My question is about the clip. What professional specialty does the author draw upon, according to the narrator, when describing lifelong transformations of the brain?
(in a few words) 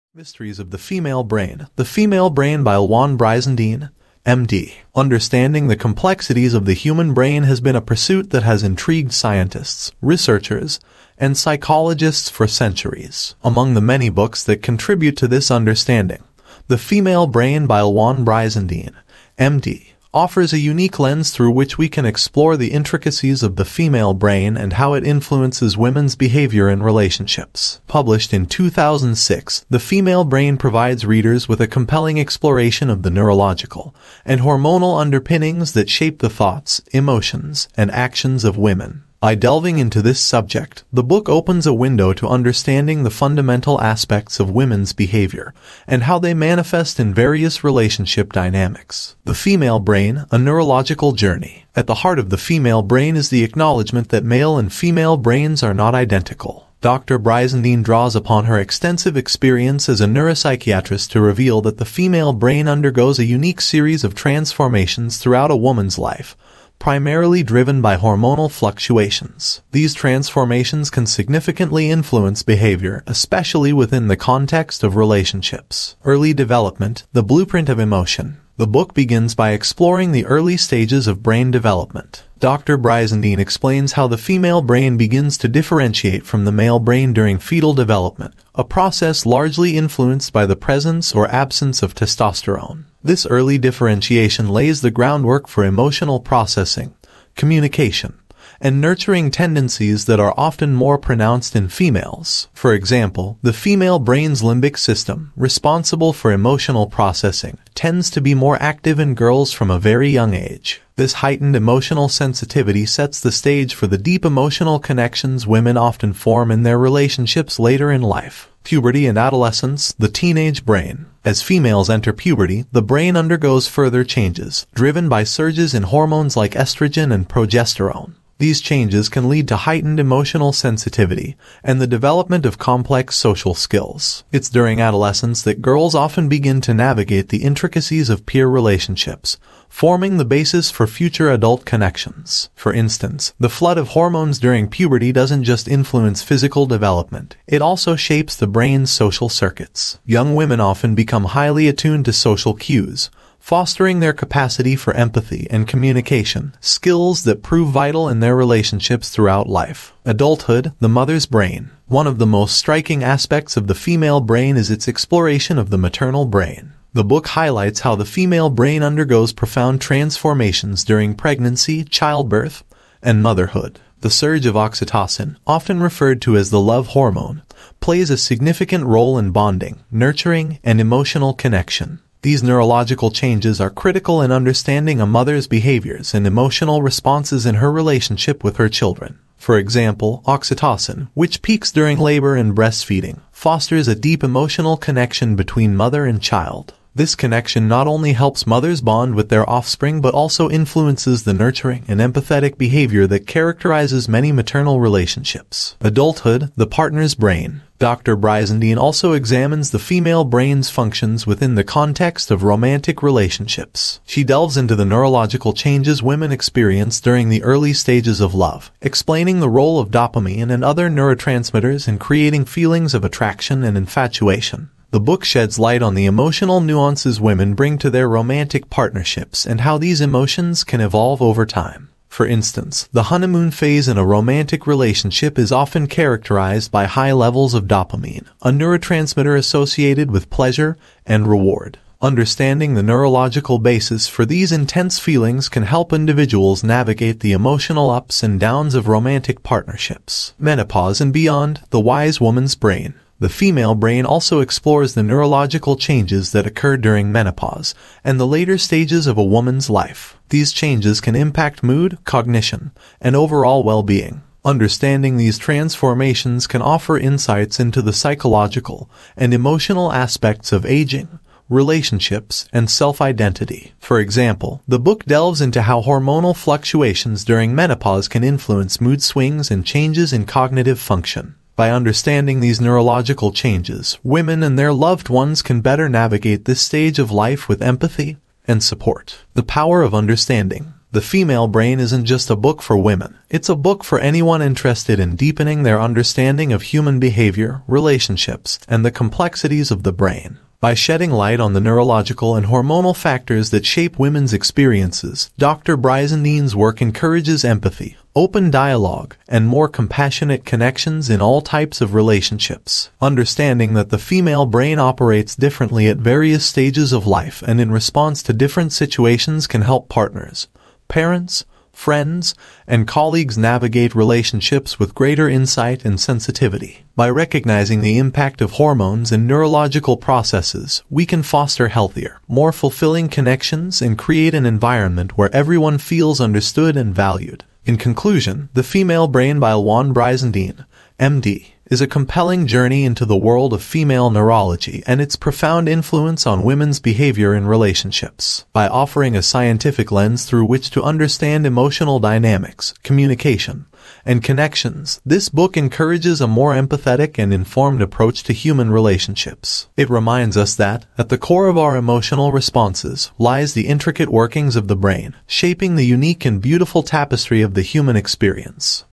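Neuropsychiatrist.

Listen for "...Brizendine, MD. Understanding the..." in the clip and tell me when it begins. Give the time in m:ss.
0:03.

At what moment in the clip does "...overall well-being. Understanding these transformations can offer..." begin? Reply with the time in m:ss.
4:23.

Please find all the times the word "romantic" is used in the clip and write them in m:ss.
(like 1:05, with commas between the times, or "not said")
3:32, 3:48, 3:54, 4:08.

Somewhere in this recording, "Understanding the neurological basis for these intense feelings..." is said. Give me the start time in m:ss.
4:02.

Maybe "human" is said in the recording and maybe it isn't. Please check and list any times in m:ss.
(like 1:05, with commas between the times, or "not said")
0:06, 4:56, 5:58, 6:07.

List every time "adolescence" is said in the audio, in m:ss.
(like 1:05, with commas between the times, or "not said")
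1:59, 2:14.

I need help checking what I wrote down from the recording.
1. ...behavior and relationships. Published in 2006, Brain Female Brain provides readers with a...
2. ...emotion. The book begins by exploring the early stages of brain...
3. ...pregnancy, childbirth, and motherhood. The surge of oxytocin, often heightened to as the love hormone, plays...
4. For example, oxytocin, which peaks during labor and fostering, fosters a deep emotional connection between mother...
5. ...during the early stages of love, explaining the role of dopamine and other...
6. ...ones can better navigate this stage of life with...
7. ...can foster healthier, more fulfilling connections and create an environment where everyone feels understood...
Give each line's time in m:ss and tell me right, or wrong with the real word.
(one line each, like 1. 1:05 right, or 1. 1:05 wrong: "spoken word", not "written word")
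1. 0:26 wrong: "The", not "Brain"
2. 1:17 right
3. 2:51 wrong: "referred", not "heightened"
4. 3:09 wrong: "breastfeeding", not "fostering"
5. 3:36 right
6. 4:45 right
7. 5:31 right.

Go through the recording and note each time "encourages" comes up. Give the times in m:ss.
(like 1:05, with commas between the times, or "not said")
5:06, 5:55.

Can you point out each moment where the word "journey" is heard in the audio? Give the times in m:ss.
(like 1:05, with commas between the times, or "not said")
0:51, 5:42.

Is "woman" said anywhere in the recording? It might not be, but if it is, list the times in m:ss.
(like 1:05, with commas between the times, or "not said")
1:05, 4:12, 4:19.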